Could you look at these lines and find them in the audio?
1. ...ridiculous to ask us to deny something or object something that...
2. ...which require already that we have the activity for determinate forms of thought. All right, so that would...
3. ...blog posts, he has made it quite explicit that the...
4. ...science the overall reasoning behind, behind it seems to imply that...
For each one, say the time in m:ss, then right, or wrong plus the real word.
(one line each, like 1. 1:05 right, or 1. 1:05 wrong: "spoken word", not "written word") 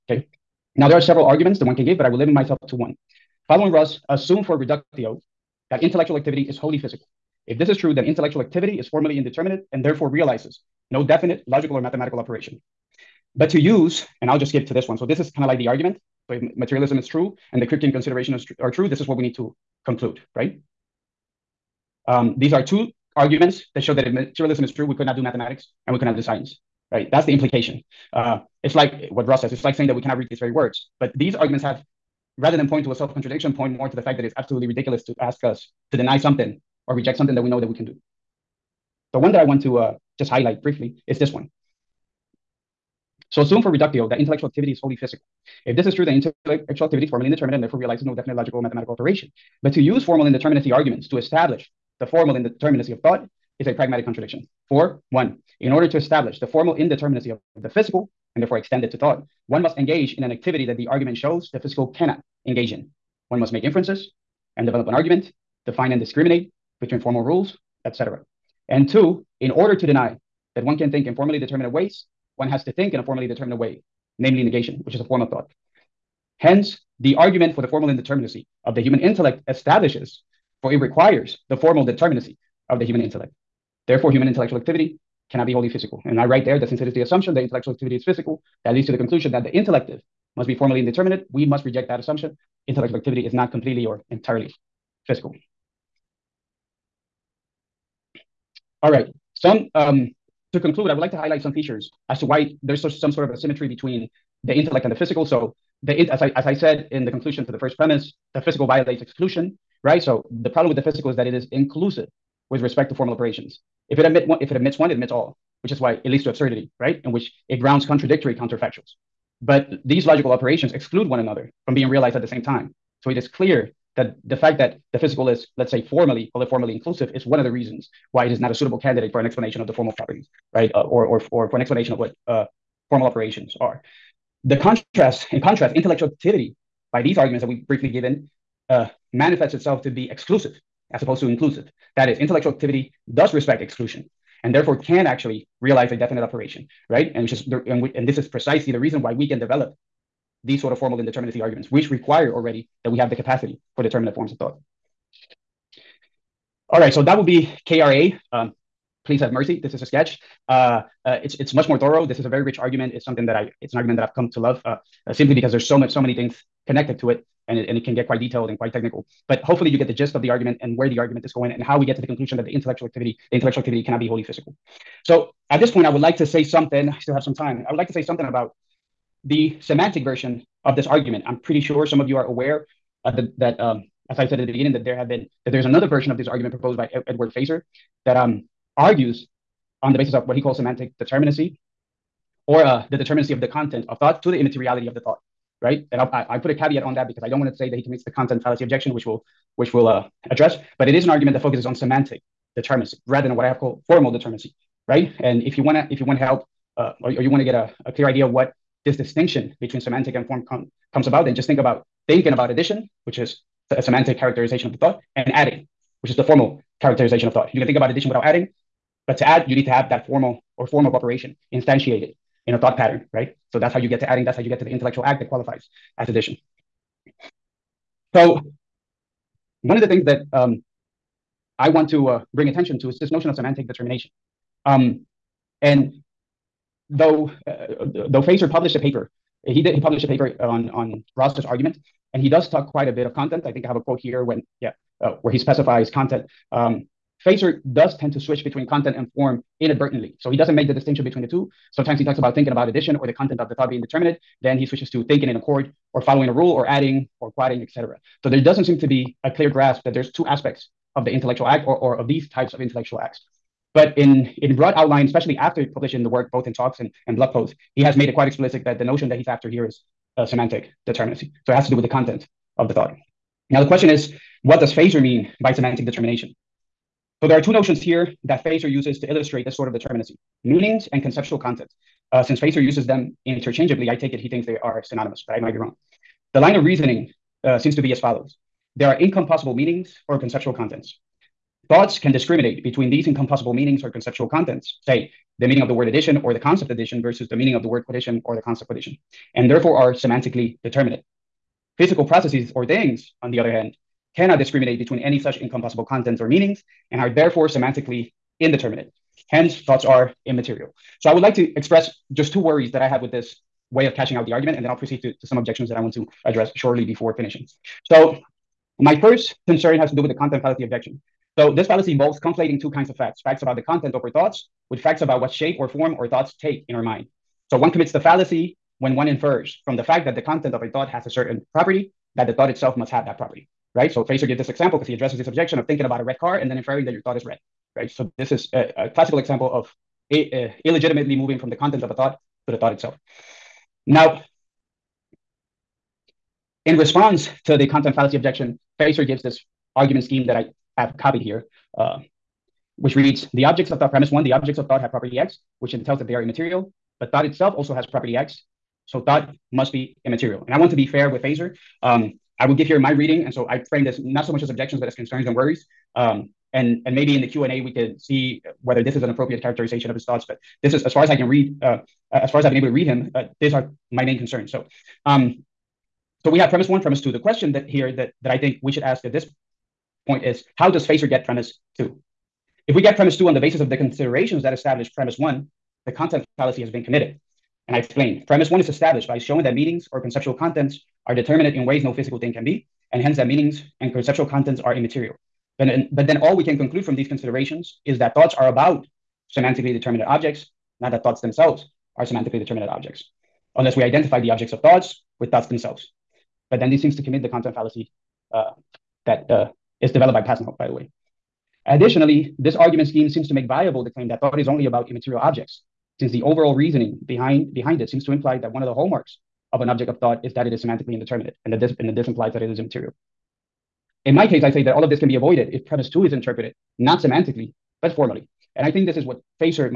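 1. 0:34 wrong: "reject", not "object"
2. 2:31 wrong: "capacity", not "activity"
3. 4:27 right
4. 6:55 wrong: "since", not "science".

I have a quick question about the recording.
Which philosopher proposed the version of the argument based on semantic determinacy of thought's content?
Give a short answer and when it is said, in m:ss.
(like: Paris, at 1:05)
Edward Feser, at 3:07.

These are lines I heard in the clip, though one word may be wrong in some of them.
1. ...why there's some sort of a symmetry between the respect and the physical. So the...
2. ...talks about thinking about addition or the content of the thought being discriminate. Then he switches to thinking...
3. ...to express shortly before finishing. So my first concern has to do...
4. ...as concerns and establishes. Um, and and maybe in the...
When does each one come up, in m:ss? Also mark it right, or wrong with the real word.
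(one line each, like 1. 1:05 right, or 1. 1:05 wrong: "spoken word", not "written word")
1. 1:42 wrong: "intellect", not "respect"
2. 4:12 wrong: "determinate", not "discriminate"
3. 5:15 wrong: "address", not "express"
4. 6:04 wrong: "worries", not "establishes".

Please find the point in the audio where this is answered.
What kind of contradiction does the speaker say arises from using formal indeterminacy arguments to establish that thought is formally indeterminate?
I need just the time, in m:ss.
0:53.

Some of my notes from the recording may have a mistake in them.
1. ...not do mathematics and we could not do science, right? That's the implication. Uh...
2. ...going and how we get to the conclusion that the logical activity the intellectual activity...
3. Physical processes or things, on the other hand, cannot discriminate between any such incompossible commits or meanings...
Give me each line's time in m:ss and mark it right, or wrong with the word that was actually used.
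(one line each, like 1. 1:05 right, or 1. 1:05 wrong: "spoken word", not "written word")
1. 0:25 right
2. 2:51 wrong: "intellectual", not "logical"
3. 5:01 wrong: "contents", not "commits".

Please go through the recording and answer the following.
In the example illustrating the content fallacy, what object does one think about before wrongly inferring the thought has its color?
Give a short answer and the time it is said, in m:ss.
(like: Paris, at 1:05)
a red car, at 5:35.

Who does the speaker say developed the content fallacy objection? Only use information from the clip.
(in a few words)
Pasnau.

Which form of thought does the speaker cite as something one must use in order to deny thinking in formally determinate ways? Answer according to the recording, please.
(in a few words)
negation.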